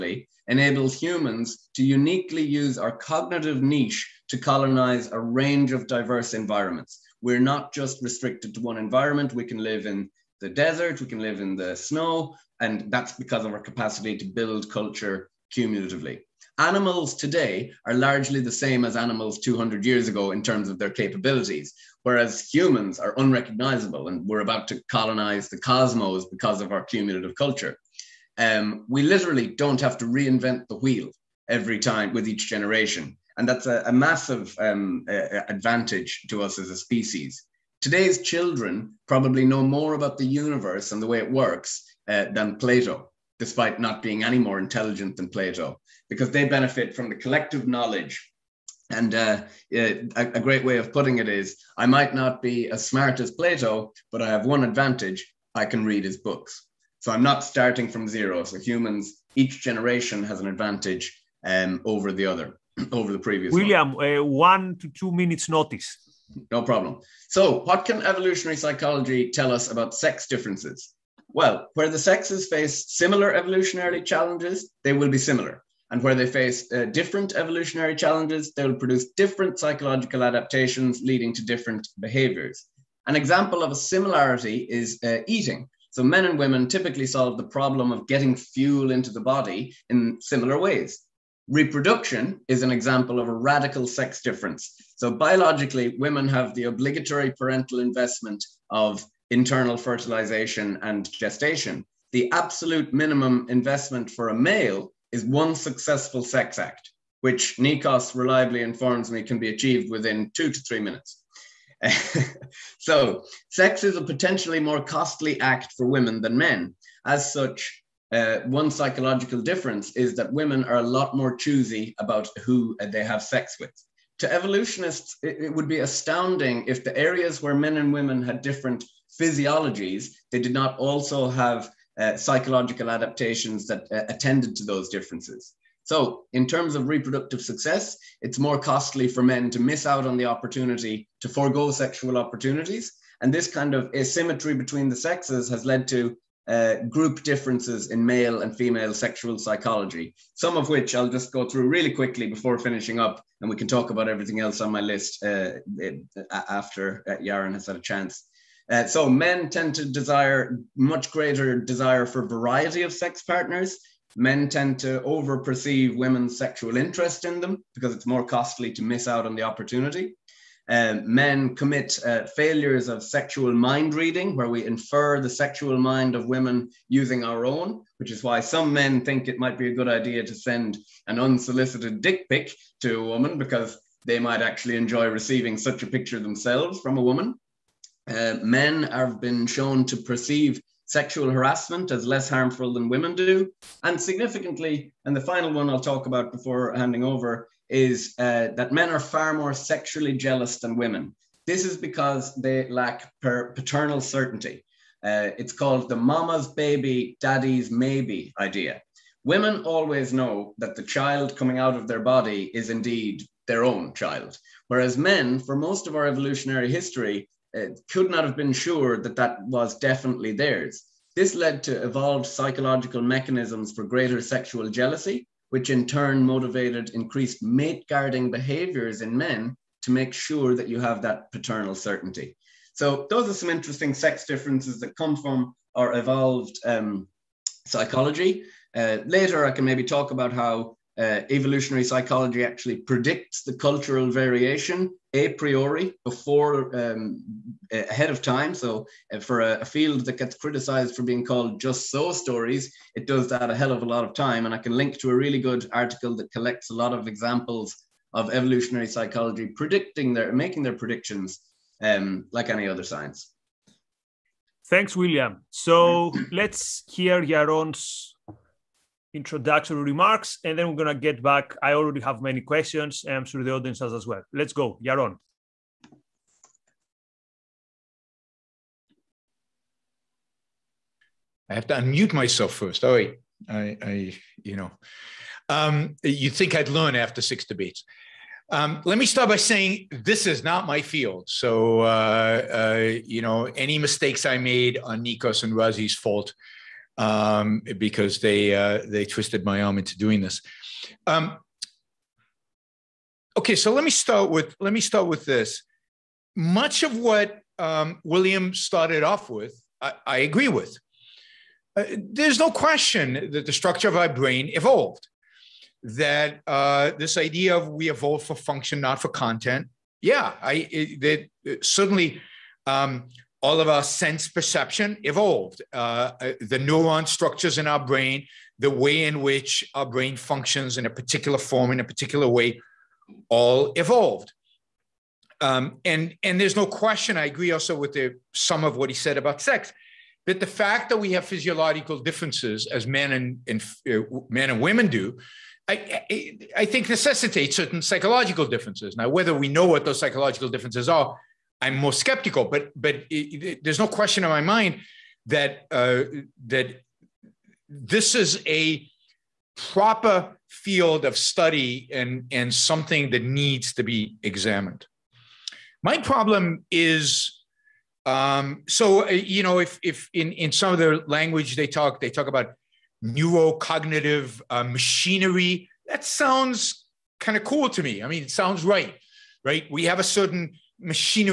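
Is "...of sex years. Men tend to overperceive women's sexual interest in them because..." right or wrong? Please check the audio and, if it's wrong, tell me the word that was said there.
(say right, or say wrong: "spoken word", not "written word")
wrong: "partners", not "years".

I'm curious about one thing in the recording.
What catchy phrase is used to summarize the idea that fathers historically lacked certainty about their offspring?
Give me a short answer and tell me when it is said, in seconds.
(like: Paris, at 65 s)
Mama's baby, daddy's maybe, at 205 s.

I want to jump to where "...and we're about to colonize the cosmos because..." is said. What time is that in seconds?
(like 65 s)
24 s.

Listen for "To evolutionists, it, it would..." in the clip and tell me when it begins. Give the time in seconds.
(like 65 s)
124 s.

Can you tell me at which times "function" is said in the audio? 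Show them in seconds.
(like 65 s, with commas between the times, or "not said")
318 s, 330 s.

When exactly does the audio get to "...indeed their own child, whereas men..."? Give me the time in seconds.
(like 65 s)
212 s.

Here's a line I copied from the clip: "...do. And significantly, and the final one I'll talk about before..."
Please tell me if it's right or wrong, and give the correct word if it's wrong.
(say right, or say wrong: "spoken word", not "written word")
right.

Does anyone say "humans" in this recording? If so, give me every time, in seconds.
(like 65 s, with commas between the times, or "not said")
0 s, 22 s, 58 s.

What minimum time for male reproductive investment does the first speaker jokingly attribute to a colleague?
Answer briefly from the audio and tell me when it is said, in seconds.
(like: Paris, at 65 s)
2 to 3 minutes, at 110 s.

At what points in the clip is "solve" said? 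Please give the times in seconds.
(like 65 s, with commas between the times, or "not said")
87 s.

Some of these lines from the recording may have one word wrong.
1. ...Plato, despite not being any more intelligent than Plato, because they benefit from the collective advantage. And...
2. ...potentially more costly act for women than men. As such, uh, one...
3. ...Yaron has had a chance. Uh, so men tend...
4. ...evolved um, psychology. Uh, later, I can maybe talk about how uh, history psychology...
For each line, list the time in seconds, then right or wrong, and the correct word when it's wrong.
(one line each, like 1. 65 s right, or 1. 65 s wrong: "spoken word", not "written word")
1. 42 s wrong: "knowledge", not "advantage"
2. 114 s right
3. 157 s right
4. 235 s wrong: "evolutionary", not "history".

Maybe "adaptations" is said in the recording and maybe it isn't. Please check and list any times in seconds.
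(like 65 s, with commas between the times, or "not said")
80 s, 132 s.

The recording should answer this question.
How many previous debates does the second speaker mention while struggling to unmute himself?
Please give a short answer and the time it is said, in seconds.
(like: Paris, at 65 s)
6, at 287 s.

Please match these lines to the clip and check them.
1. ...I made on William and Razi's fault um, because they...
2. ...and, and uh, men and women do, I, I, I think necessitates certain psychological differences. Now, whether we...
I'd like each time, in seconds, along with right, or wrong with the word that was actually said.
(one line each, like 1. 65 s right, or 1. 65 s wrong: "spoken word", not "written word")
1. 294 s wrong: "Nikos", not "William"
2. 343 s right.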